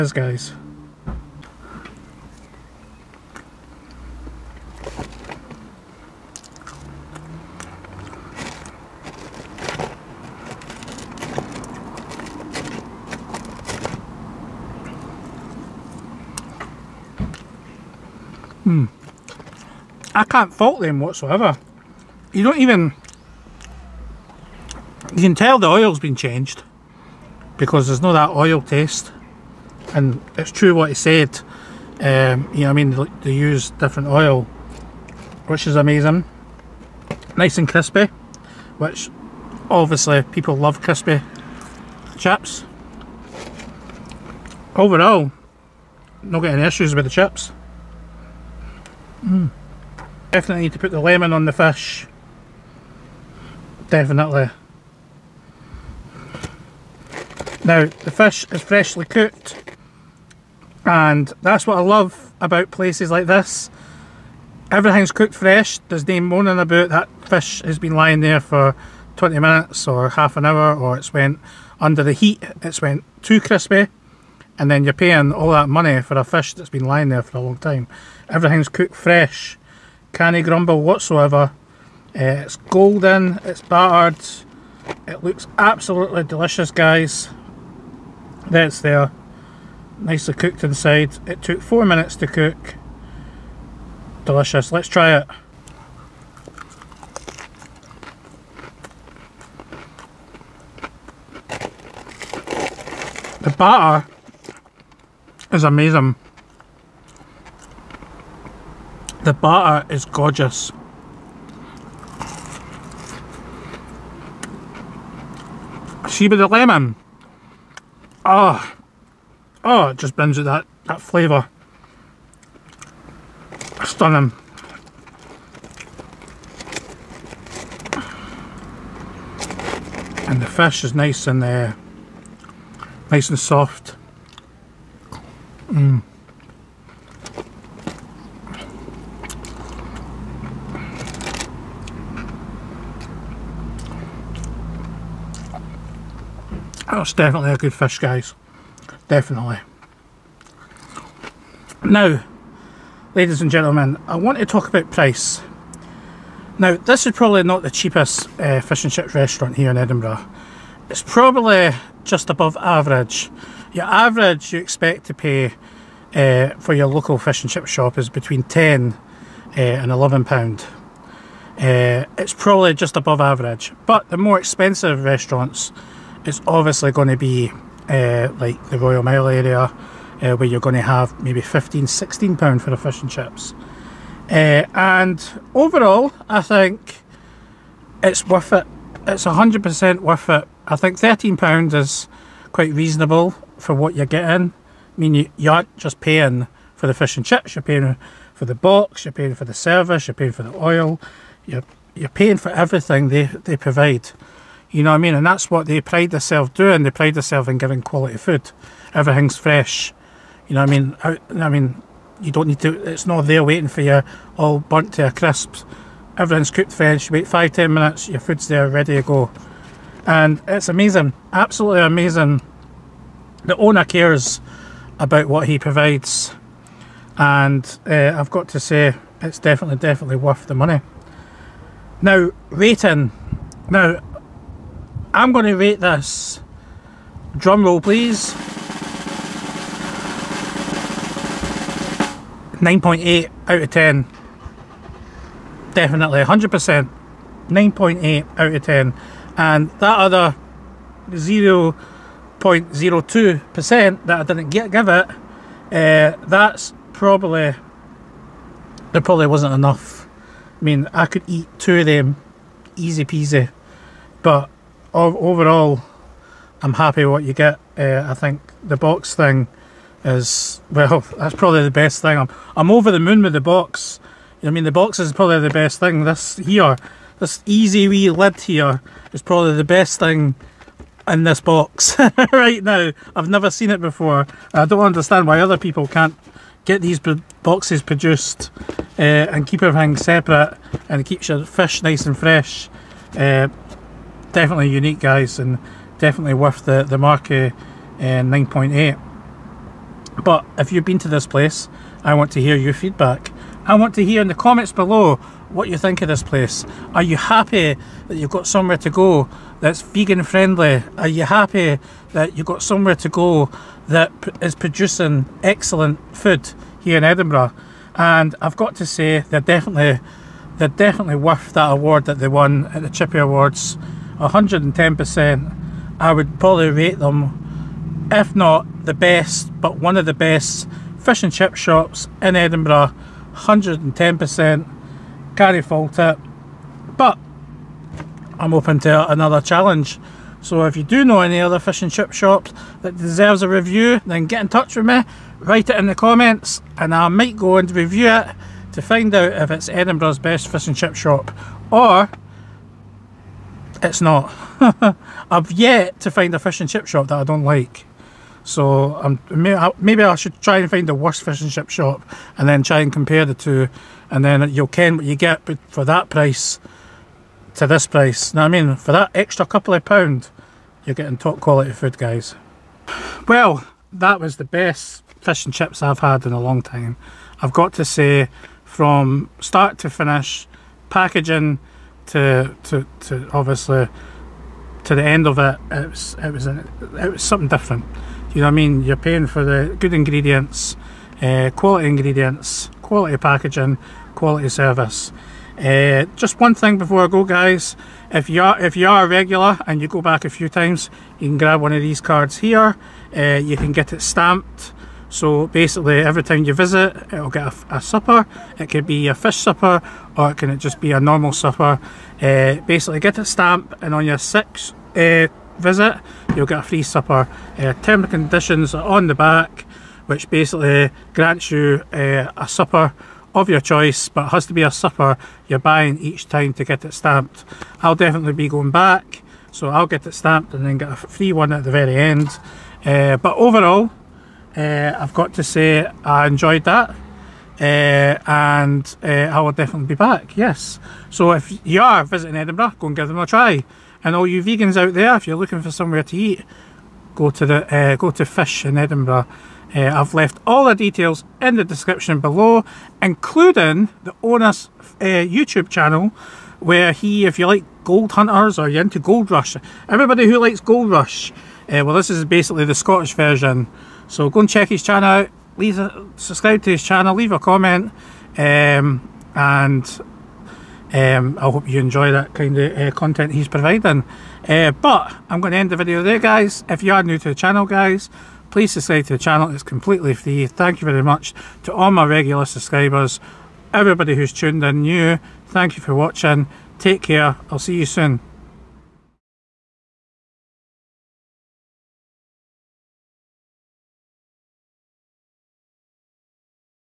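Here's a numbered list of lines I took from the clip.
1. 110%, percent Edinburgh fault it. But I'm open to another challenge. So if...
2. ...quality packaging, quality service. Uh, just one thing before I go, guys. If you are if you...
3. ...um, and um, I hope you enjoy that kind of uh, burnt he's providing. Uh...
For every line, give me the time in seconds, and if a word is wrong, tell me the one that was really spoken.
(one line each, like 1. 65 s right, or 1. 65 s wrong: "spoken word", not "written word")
1. 333 s wrong: "Carry", not "Edinburgh"
2. 392 s right
3. 468 s wrong: "content", not "burnt".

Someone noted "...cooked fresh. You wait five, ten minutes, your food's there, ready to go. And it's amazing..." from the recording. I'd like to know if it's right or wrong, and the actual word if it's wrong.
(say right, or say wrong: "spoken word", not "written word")
right.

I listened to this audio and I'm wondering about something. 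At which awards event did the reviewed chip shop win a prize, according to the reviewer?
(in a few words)
Chippy Awards.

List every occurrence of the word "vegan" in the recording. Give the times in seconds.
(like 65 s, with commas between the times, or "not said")
309 s, 444 s.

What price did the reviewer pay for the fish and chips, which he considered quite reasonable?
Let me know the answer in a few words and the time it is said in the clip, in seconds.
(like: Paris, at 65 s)
£13, at 190 s.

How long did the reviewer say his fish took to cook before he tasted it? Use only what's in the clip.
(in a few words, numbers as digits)
4 minutes.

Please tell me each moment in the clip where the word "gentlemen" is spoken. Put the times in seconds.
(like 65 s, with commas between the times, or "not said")
153 s.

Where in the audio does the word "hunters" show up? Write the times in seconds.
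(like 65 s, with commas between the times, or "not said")
458 s.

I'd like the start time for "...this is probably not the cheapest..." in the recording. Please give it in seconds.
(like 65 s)
156 s.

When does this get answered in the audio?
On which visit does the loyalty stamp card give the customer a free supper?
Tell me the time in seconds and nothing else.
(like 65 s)
414 s.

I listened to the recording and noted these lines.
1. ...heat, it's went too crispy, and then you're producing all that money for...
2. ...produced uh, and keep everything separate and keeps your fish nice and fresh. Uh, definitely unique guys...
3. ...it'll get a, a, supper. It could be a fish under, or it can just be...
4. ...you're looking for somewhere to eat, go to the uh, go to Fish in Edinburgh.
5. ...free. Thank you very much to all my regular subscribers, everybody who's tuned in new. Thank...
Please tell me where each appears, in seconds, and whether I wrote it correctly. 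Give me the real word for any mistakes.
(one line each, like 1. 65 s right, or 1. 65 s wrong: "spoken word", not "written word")
1. 72 s wrong: "paying", not "producing"
2. 287 s right
3. 407 s wrong: "supper", not "under"
4. 445 s right
5. 480 s right.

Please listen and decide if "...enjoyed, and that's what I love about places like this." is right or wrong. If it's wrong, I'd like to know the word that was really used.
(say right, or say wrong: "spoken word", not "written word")
wrong: "cooked", not "enjoyed".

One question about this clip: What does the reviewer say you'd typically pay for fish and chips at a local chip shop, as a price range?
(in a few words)
£10 to £11.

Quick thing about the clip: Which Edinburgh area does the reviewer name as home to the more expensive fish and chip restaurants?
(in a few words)
Royal Mile.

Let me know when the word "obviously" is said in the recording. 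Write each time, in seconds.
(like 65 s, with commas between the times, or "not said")
39 s, 176 s, 383 s.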